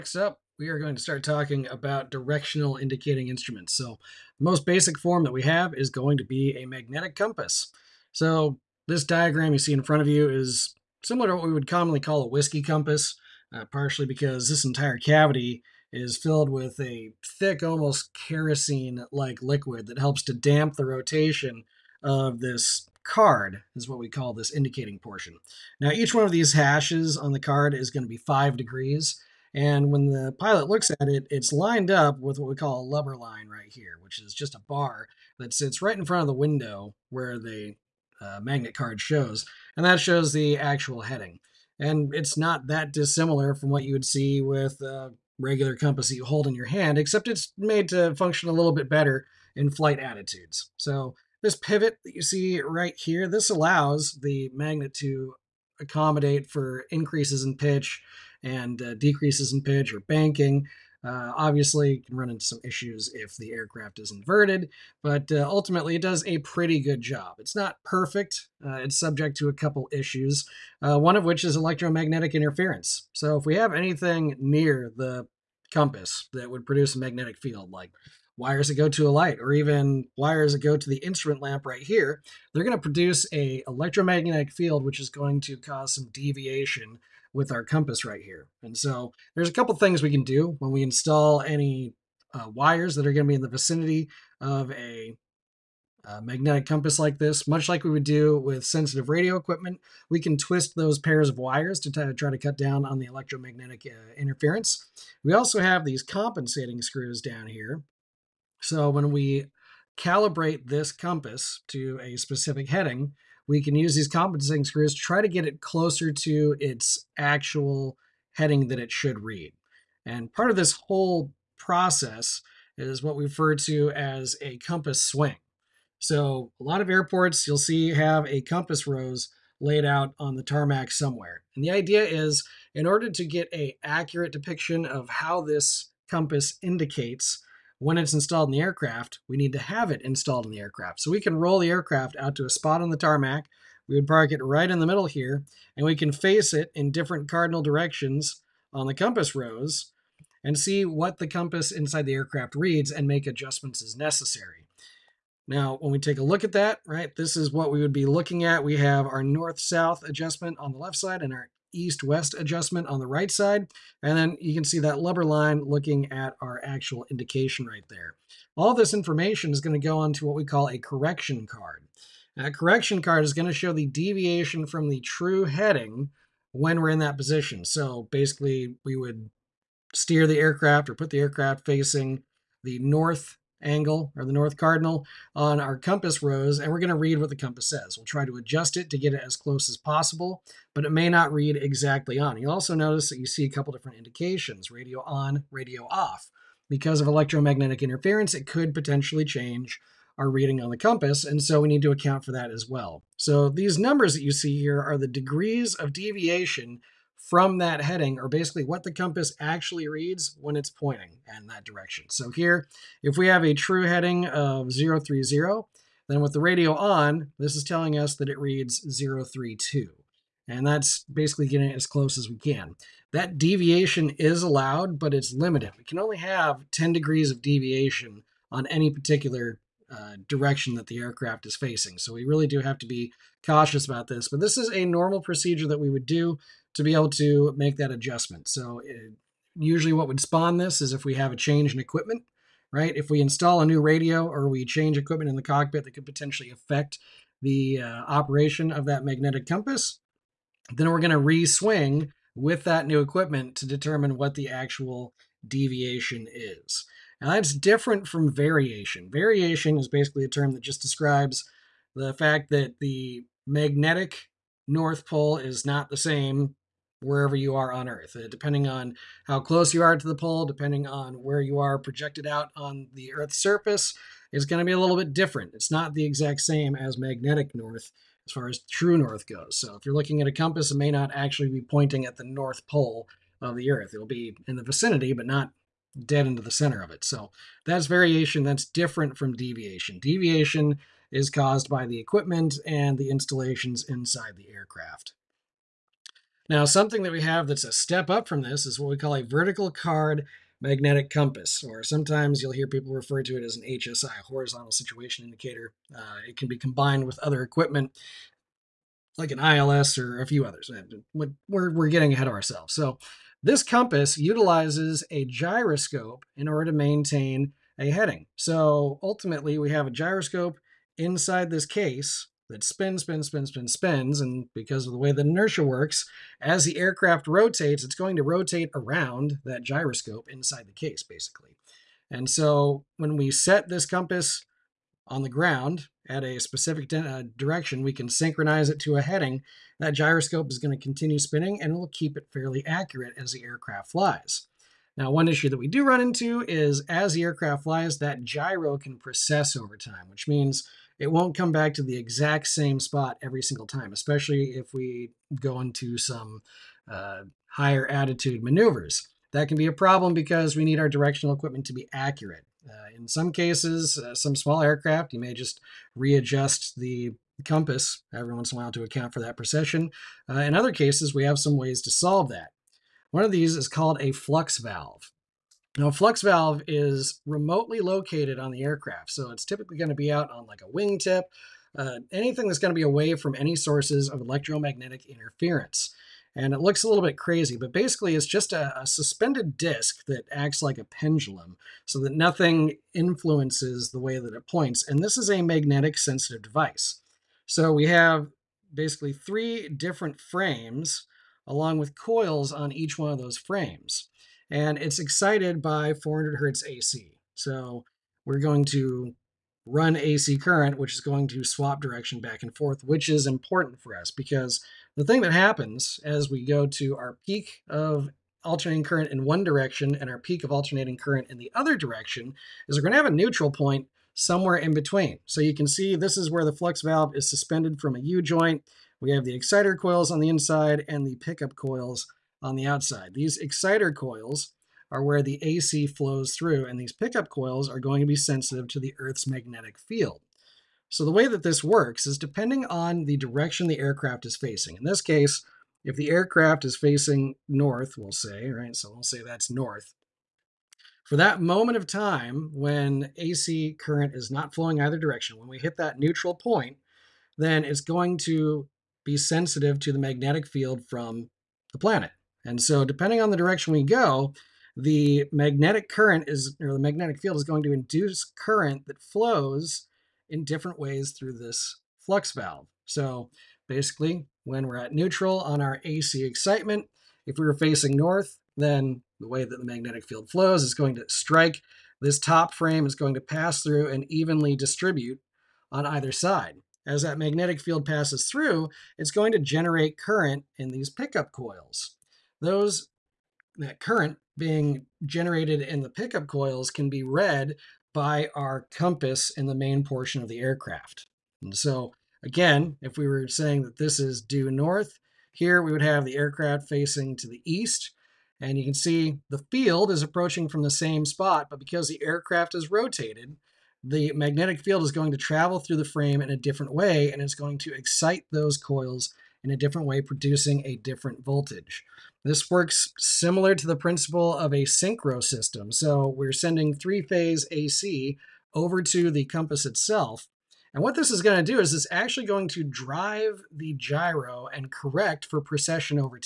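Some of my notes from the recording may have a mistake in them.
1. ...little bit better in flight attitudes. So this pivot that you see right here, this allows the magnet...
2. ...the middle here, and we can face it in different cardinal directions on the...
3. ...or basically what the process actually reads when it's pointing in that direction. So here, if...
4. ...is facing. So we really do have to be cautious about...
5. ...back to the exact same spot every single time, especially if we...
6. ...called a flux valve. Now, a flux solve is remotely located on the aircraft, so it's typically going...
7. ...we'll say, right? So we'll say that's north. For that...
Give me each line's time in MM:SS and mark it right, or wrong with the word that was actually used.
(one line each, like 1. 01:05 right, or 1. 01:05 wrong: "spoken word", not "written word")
1. 00:48 right
2. 02:24 right
3. 03:28 wrong: "compass", not "process"
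4. 03:51 right
5. 05:51 right
6. 06:13 wrong: "valve", not "solve"
7. 07:27 right.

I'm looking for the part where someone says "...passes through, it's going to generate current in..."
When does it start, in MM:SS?
08:07.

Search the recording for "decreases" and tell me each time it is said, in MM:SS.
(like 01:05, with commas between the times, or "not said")
00:58.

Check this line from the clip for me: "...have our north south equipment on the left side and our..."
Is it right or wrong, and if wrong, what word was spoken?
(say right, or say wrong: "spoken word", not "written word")
wrong: "adjustment", not "equipment".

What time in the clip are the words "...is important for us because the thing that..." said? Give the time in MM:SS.
06:53.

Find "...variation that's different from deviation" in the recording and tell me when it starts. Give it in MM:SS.
04:47.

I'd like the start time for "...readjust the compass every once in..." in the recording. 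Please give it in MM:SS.
06:05.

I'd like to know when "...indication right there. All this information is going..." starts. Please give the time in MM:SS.
02:47.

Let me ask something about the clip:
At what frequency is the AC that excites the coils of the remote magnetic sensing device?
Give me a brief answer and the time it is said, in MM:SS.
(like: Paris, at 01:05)
400 hertz, at 06:45.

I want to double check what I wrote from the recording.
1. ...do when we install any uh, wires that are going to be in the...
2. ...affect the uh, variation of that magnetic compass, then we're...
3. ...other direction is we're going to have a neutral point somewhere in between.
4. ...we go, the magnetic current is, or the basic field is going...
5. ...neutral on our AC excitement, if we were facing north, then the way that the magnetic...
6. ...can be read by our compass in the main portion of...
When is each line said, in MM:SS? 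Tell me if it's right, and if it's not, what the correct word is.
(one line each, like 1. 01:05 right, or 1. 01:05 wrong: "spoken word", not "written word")
1. 01:30 right
2. 04:06 wrong: "operation", not "variation"
3. 07:01 right
4. 07:43 wrong: "magnetic", not "basic"
5. 07:54 right
6. 08:16 right.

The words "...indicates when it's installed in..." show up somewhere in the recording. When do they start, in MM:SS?
02:16.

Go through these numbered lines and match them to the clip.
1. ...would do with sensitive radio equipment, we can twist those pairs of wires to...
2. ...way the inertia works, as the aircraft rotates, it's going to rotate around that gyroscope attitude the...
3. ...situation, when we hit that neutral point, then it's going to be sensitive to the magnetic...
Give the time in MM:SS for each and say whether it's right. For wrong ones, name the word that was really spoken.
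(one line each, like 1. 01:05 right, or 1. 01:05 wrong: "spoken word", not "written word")
1. 01:37 right
2. 05:24 wrong: "inside", not "attitude"
3. 07:34 wrong: "direction", not "situation".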